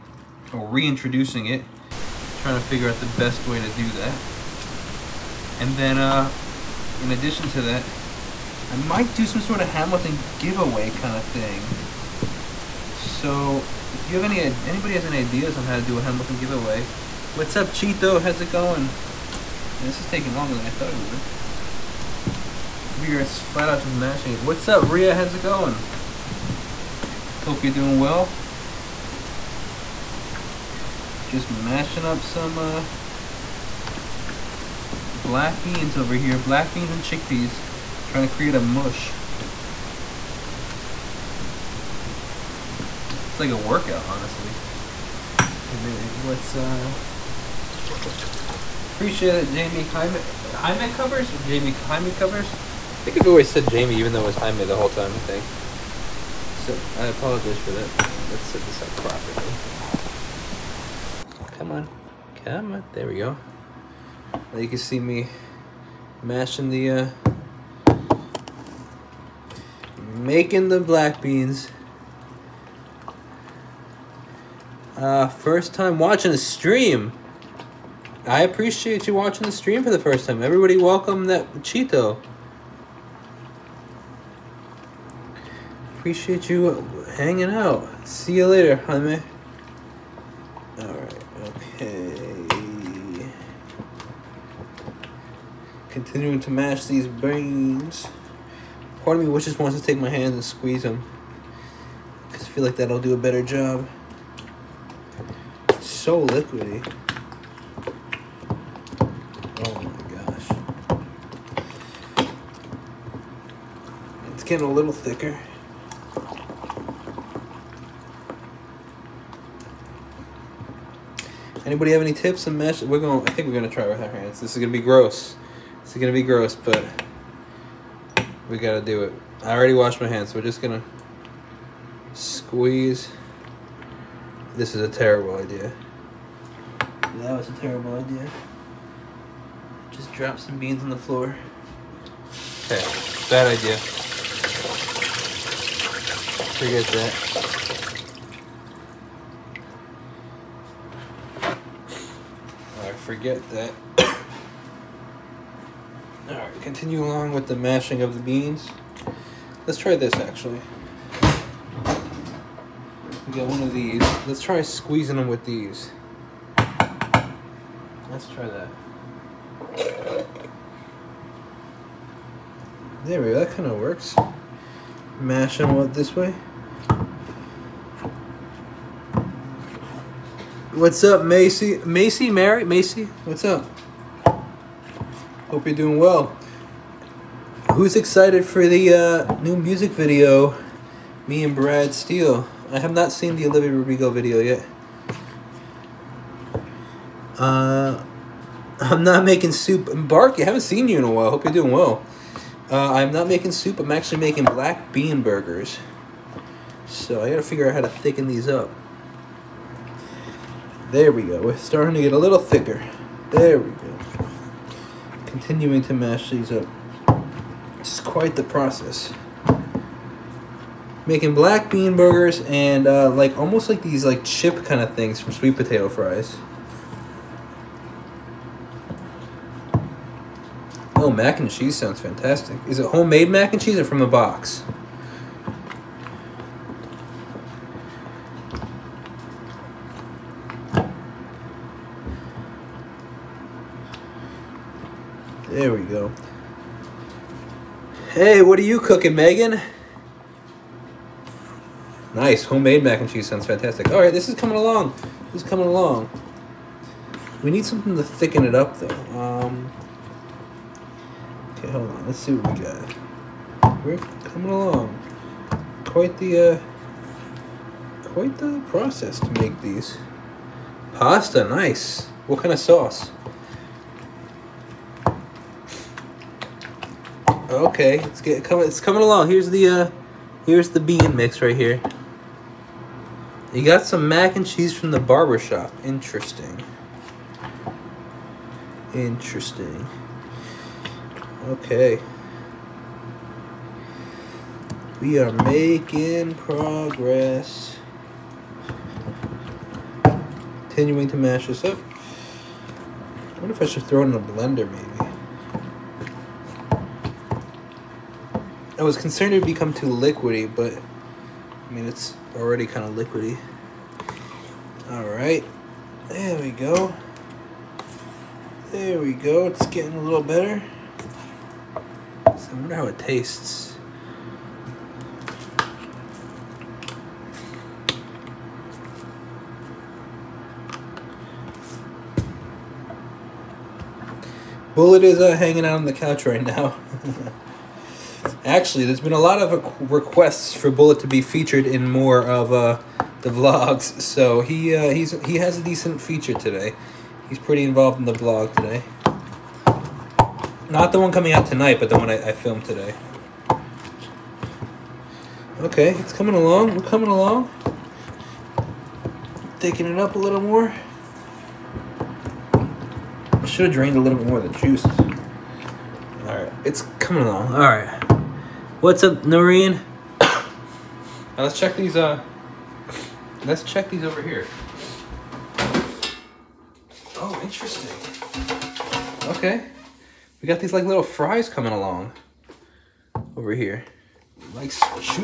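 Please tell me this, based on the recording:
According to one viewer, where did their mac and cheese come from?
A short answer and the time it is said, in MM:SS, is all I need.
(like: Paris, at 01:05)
The barber shop, at 04:44.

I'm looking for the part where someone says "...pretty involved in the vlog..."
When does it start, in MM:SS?
05:47.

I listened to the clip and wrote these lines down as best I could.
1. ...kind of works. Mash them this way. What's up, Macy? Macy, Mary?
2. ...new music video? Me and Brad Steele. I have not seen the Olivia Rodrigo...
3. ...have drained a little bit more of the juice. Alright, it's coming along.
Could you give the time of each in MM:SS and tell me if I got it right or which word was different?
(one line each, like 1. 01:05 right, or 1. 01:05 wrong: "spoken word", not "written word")
1. 02:53 right
2. 03:09 right
3. 06:03 right.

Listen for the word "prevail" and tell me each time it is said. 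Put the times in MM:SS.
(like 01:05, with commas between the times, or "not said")
not said.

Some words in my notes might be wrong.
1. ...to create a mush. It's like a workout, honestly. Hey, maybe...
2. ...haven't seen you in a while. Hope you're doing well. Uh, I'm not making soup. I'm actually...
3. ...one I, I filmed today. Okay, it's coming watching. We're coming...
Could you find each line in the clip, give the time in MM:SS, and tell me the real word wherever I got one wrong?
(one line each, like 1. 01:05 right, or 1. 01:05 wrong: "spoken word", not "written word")
1. 00:38 right
2. 03:20 right
3. 05:51 wrong: "along", not "watching".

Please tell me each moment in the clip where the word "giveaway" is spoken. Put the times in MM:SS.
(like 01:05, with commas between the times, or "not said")
00:10, 00:16.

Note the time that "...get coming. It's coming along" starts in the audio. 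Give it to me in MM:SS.
04:38.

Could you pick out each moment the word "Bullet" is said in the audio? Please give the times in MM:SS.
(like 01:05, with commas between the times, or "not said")
05:34, 05:40.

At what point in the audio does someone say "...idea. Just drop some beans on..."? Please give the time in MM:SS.
02:17.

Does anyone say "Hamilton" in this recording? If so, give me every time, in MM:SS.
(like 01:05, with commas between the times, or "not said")
00:09, 00:16.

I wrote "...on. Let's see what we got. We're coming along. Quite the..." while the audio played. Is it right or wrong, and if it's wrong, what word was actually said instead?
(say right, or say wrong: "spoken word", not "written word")
right.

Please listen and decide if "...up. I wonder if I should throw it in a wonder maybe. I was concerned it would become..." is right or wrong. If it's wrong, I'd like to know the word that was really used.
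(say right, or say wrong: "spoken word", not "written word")
wrong: "blender", not "wonder".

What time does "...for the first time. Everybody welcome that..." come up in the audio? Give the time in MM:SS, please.
01:19.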